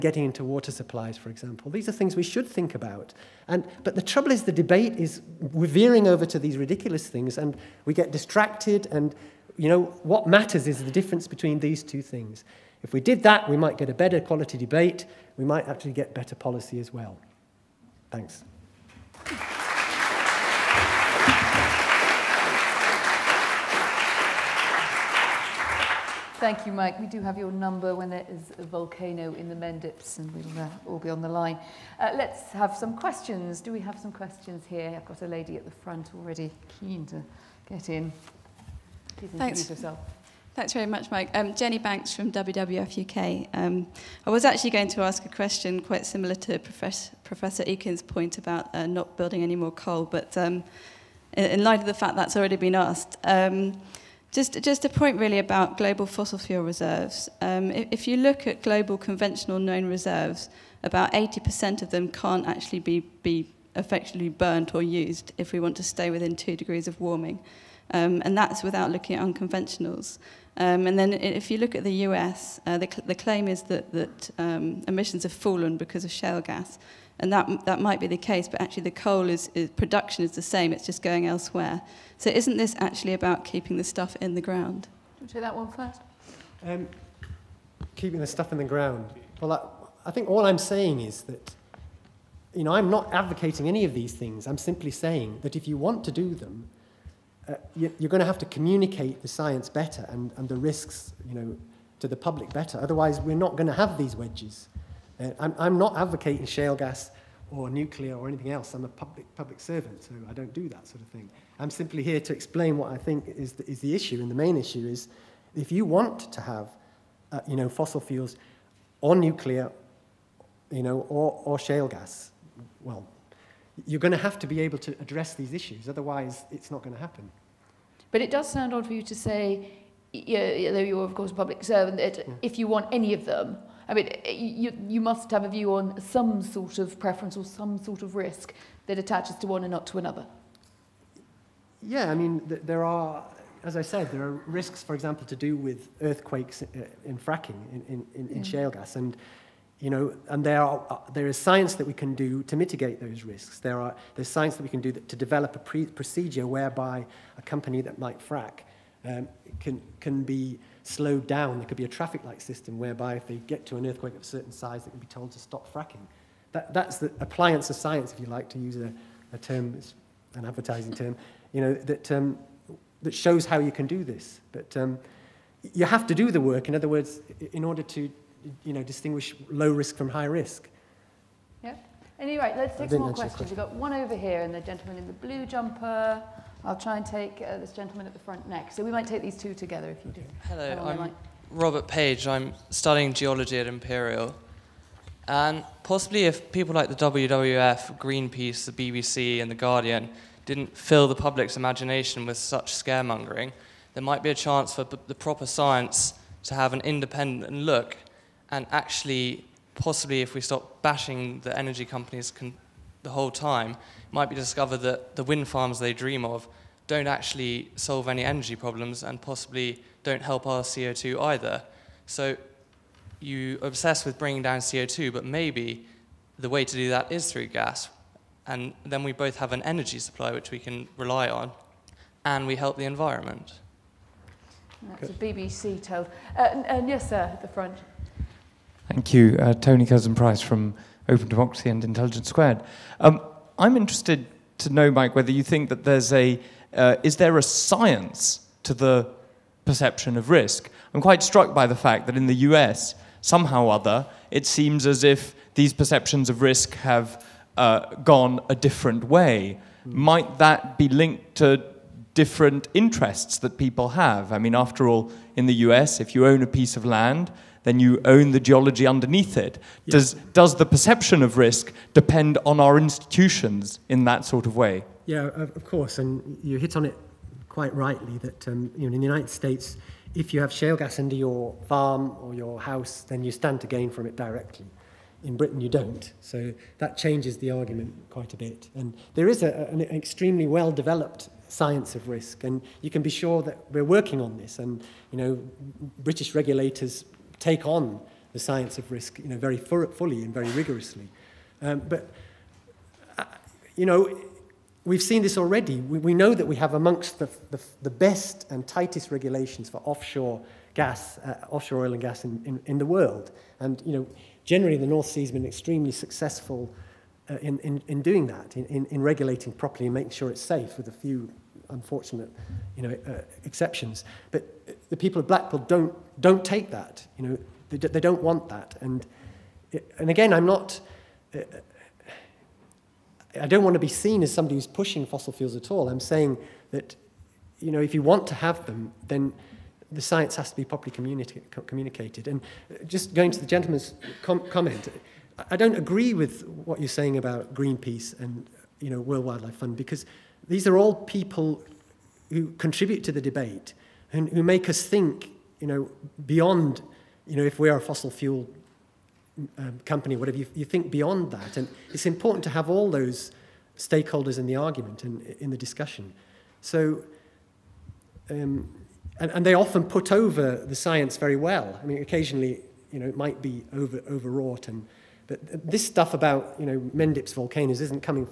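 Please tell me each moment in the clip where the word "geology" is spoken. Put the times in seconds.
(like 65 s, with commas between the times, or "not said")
193 s, 268 s.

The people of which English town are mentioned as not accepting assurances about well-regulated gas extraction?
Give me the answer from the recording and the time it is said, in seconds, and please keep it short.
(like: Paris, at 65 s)
Blackpool, at 325 s.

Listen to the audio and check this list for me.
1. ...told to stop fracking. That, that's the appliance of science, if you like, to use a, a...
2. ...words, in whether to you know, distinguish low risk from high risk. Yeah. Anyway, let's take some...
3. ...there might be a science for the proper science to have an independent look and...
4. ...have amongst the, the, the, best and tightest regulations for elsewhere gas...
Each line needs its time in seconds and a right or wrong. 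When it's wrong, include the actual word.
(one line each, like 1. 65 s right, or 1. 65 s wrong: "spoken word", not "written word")
1. 165 s right
2. 176 s wrong: "order", not "whether"
3. 203 s wrong: "chance", not "science"
4. 306 s wrong: "offshore", not "elsewhere".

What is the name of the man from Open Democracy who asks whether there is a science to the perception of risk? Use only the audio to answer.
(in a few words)
Tony Curzon Price.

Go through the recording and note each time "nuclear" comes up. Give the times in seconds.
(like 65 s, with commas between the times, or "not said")
107 s, 119 s.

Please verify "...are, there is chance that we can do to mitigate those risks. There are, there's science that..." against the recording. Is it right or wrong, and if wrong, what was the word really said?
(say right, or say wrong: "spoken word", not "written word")
wrong: "science", not "chance".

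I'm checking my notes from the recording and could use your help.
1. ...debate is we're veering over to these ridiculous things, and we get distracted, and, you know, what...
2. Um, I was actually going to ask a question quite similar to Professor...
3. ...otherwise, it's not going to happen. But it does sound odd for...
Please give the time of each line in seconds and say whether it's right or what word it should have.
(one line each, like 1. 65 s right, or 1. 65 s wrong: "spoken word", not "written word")
1. 4 s right
2. 43 s right
3. 125 s right.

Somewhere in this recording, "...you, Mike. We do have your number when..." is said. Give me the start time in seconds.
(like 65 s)
26 s.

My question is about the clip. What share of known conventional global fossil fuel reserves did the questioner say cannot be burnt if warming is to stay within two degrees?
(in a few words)
80%.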